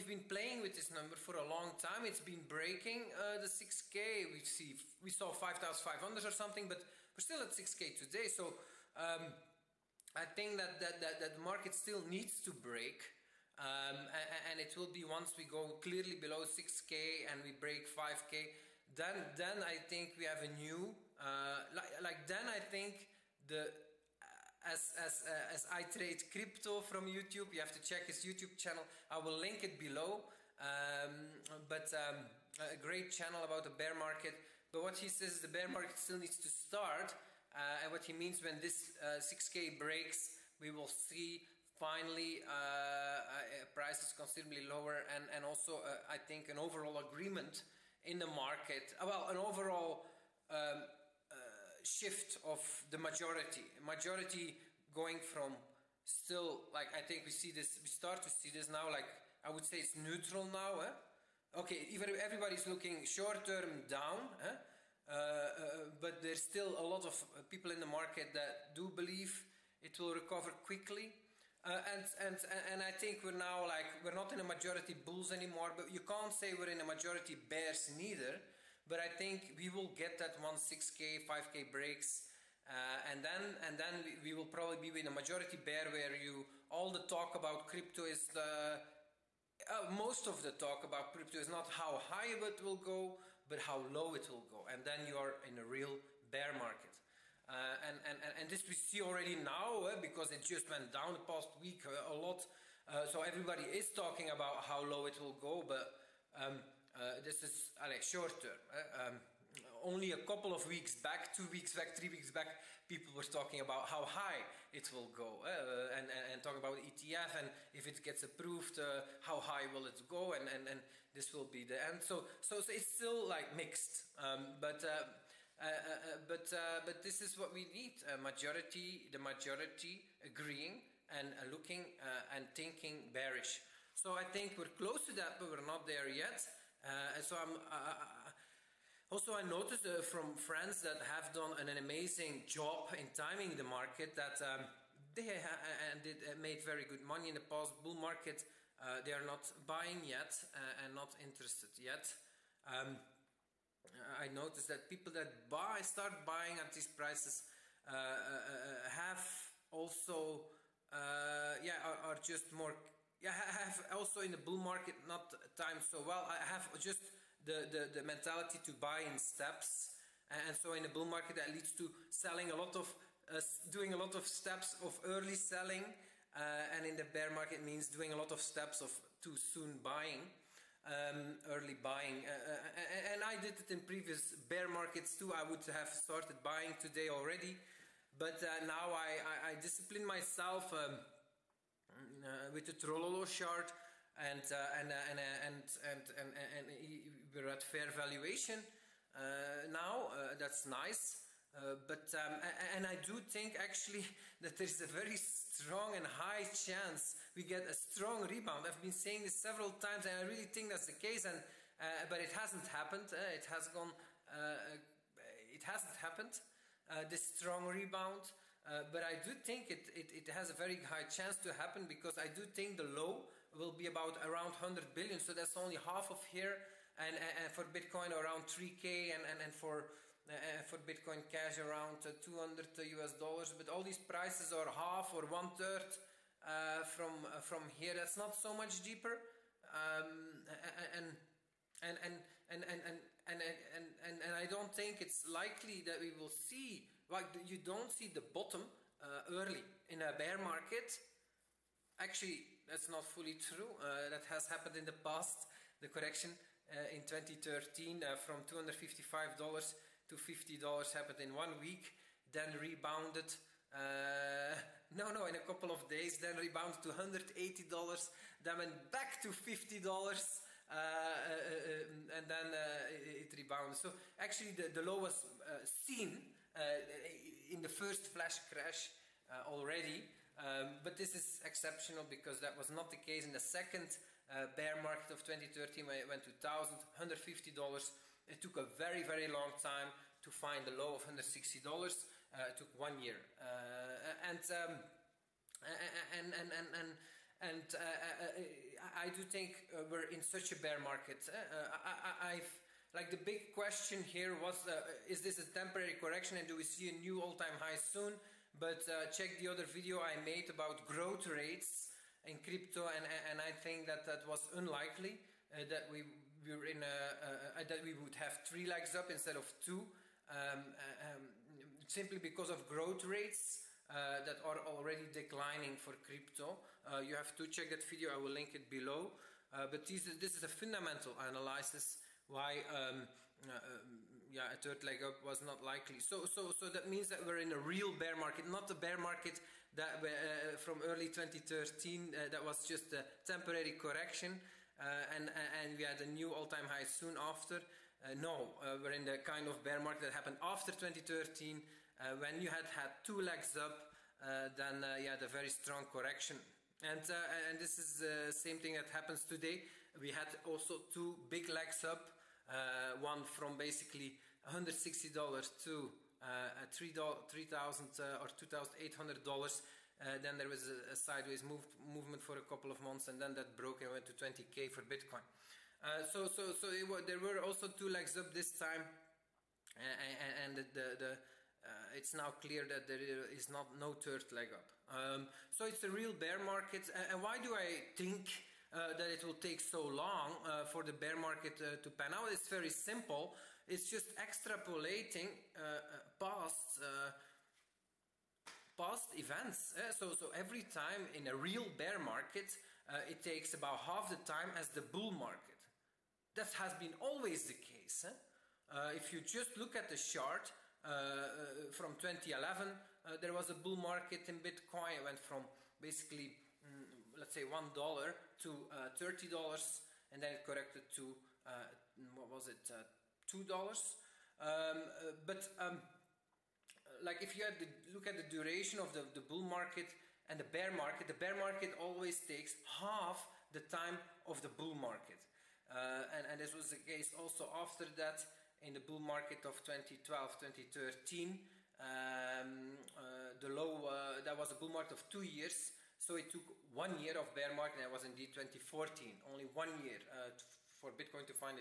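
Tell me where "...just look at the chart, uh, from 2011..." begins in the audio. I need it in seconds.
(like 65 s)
409 s.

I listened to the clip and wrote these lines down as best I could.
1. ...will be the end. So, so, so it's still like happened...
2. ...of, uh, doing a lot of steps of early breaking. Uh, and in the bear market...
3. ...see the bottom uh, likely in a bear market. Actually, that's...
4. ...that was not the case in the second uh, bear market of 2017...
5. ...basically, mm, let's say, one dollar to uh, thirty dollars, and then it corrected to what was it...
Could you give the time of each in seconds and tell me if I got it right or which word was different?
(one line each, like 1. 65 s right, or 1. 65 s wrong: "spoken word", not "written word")
1. 121 s wrong: "mixed", not "happened"
2. 172 s wrong: "selling", not "breaking"
3. 247 s wrong: "early", not "likely"
4. 282 s wrong: "2013", not "2017"
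5. 415 s right.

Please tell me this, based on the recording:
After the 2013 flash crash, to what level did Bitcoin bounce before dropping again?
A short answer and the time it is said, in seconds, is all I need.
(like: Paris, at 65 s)
$180, at 266 s.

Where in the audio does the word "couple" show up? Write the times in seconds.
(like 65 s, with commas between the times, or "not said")
110 s, 265 s, 372 s.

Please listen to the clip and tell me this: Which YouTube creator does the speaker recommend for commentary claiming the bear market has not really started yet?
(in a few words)
iTradeCrypto.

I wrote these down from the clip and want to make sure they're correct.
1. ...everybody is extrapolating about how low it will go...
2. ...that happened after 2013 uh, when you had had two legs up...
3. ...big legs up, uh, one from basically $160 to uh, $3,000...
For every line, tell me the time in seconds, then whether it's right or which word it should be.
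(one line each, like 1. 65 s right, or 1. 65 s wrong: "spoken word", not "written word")
1. 103 s wrong: "talking", not "extrapolating"
2. 350 s right
3. 361 s right.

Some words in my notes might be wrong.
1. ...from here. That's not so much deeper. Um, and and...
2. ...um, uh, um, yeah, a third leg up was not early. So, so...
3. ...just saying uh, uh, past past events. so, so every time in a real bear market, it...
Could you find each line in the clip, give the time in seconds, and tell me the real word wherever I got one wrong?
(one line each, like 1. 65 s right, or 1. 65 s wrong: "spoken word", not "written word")
1. 237 s right
2. 332 s wrong: "likely", not "early"
3. 393 s wrong: "extrapolating", not "saying".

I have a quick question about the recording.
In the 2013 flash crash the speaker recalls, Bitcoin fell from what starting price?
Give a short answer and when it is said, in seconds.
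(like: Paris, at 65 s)
$255, at 258 s.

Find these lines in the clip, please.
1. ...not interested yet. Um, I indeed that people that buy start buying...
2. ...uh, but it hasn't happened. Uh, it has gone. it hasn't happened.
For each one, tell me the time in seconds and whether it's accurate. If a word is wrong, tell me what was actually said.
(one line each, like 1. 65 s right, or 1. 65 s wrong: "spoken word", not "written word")
1. 150 s wrong: "noticed", not "indeed"
2. 211 s right.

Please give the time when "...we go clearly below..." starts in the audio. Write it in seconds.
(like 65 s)
15 s.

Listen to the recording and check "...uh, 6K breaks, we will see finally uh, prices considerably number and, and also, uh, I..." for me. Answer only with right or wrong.
wrong.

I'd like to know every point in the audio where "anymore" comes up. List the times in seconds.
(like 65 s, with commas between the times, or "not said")
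75 s.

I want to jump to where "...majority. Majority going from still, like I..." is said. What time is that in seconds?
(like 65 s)
52 s.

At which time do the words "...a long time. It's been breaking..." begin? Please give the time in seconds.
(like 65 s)
1 s.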